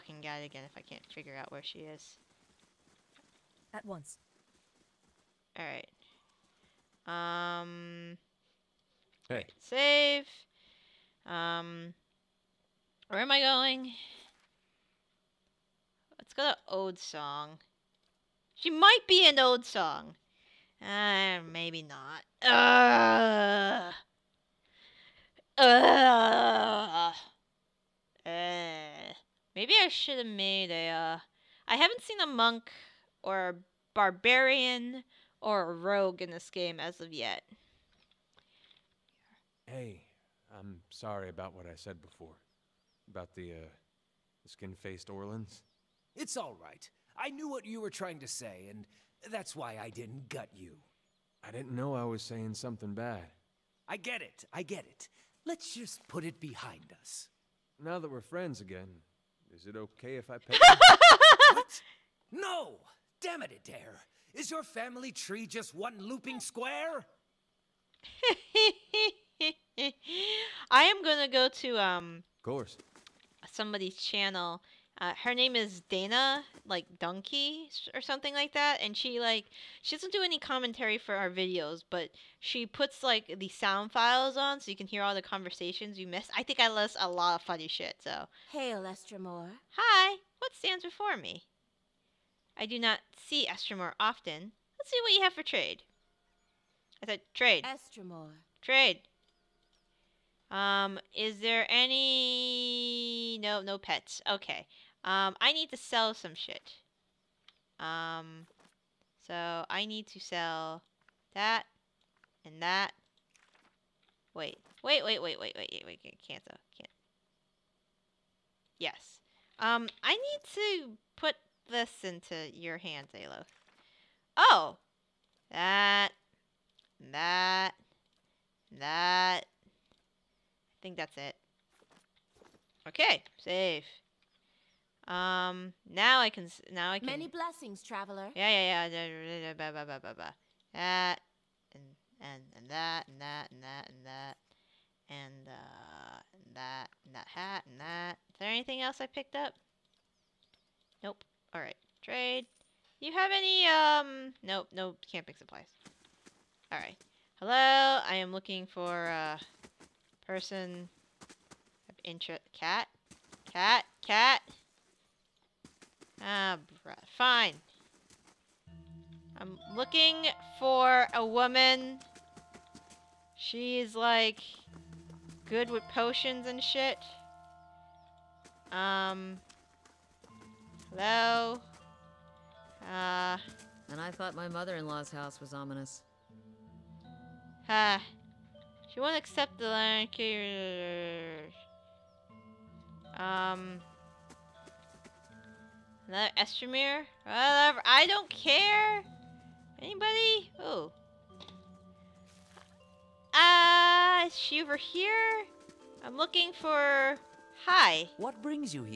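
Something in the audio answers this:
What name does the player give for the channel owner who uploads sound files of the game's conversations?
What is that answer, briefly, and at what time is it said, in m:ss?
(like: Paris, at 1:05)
Dana, at 1:15.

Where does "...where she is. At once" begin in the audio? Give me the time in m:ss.
0:01.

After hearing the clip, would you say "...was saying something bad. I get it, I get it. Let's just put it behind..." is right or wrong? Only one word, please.
right.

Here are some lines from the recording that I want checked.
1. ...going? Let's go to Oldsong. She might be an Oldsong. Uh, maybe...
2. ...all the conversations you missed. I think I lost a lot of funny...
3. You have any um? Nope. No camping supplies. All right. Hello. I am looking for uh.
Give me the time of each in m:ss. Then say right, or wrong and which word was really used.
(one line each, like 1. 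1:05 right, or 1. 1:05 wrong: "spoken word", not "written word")
1. 0:13 right
2. 1:25 right
3. 2:32 right.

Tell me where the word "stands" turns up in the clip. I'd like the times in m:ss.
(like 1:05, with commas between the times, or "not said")
1:30.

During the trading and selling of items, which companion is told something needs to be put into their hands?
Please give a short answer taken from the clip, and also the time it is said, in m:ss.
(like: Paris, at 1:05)
Aloth, at 2:03.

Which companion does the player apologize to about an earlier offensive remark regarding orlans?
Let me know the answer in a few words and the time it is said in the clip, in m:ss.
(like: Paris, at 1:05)
Edér, at 1:03.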